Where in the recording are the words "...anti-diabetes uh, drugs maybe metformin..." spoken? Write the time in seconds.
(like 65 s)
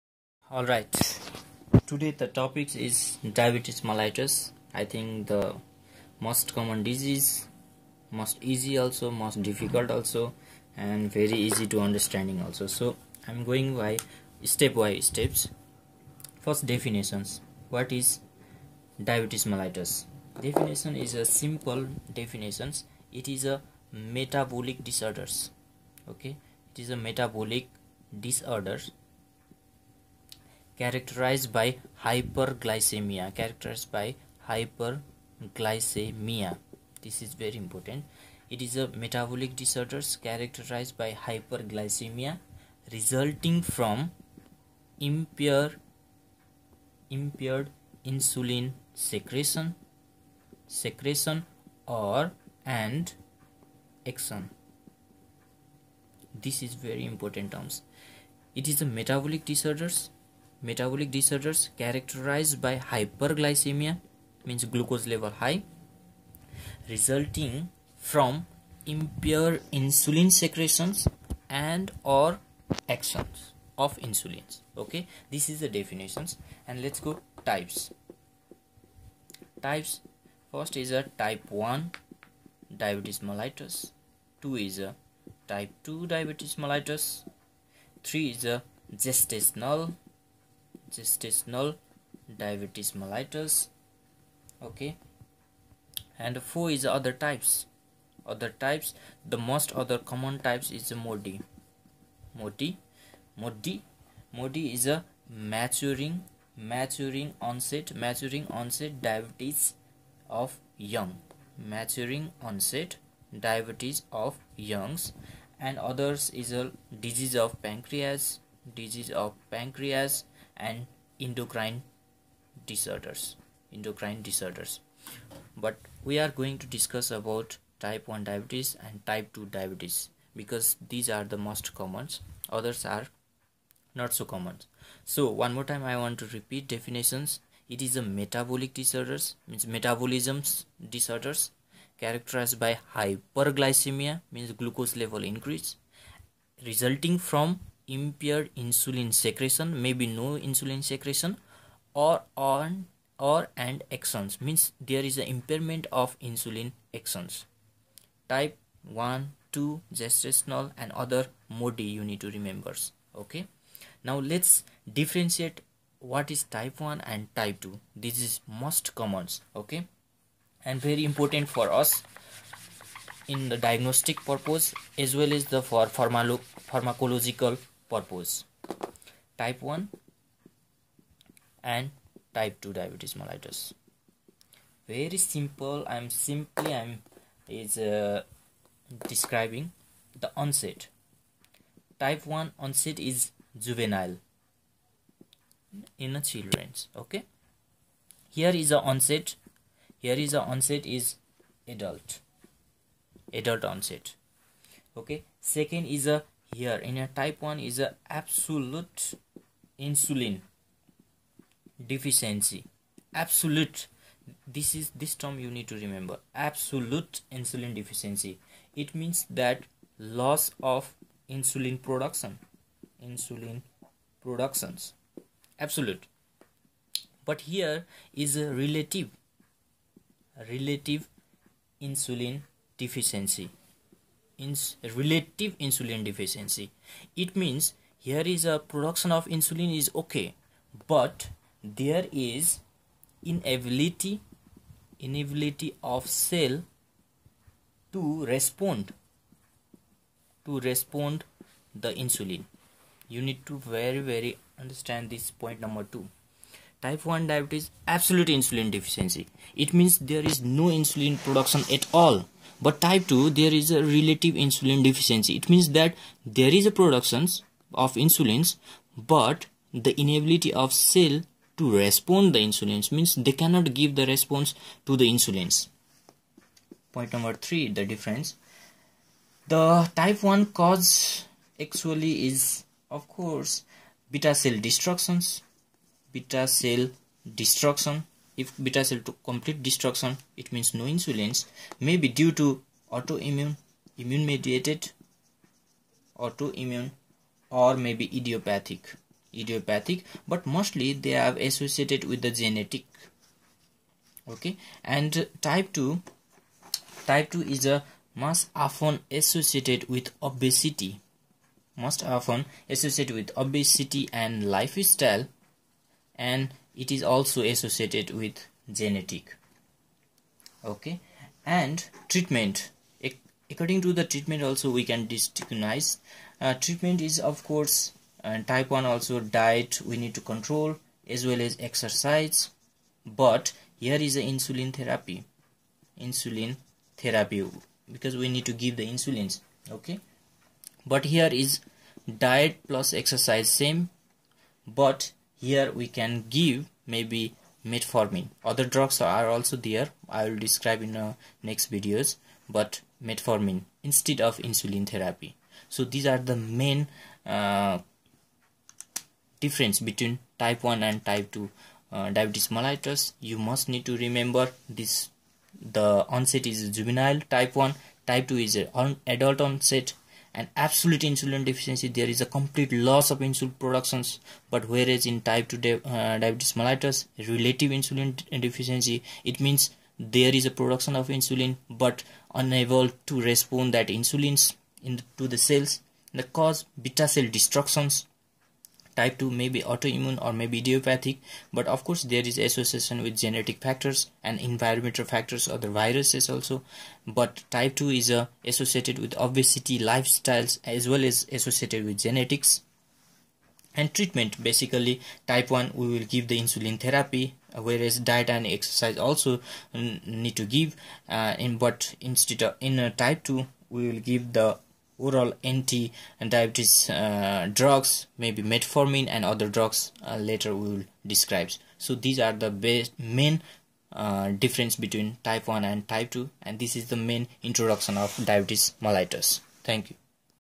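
415 s.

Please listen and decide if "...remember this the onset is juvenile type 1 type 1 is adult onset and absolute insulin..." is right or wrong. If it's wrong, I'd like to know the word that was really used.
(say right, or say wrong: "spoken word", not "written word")
wrong: "2", not "1".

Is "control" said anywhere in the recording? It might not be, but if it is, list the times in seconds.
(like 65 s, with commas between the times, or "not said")
330 s.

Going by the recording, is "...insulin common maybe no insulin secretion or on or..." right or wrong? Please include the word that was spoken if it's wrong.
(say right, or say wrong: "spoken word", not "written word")
wrong: "secretion", not "common".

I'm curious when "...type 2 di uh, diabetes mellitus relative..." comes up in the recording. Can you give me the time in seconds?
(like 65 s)
375 s.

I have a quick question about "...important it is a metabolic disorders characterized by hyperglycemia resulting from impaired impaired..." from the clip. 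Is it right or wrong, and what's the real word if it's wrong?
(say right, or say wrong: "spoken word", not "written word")
right.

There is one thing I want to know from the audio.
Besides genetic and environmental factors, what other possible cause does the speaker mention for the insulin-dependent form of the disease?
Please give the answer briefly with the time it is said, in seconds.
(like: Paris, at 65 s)
viruses, at 395 s.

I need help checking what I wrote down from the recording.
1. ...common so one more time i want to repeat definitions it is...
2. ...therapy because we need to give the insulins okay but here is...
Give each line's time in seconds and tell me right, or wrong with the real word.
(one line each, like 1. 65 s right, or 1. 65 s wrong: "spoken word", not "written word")
1. 134 s right
2. 337 s right.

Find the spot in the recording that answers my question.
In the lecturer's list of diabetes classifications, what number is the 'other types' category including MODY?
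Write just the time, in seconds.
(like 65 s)
96 s.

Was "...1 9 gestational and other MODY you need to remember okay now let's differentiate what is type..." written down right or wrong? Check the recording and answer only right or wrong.
wrong.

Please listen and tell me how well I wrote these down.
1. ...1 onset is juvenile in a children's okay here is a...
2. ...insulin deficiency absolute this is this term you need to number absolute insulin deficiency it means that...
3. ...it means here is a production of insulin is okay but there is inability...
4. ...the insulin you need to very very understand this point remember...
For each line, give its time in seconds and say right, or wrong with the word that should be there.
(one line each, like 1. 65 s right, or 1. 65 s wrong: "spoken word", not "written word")
1. 192 s right
2. 209 s wrong: "remember", not "number"
3. 237 s right
4. 251 s wrong: "number", not "remember".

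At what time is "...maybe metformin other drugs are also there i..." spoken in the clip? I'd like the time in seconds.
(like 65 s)
346 s.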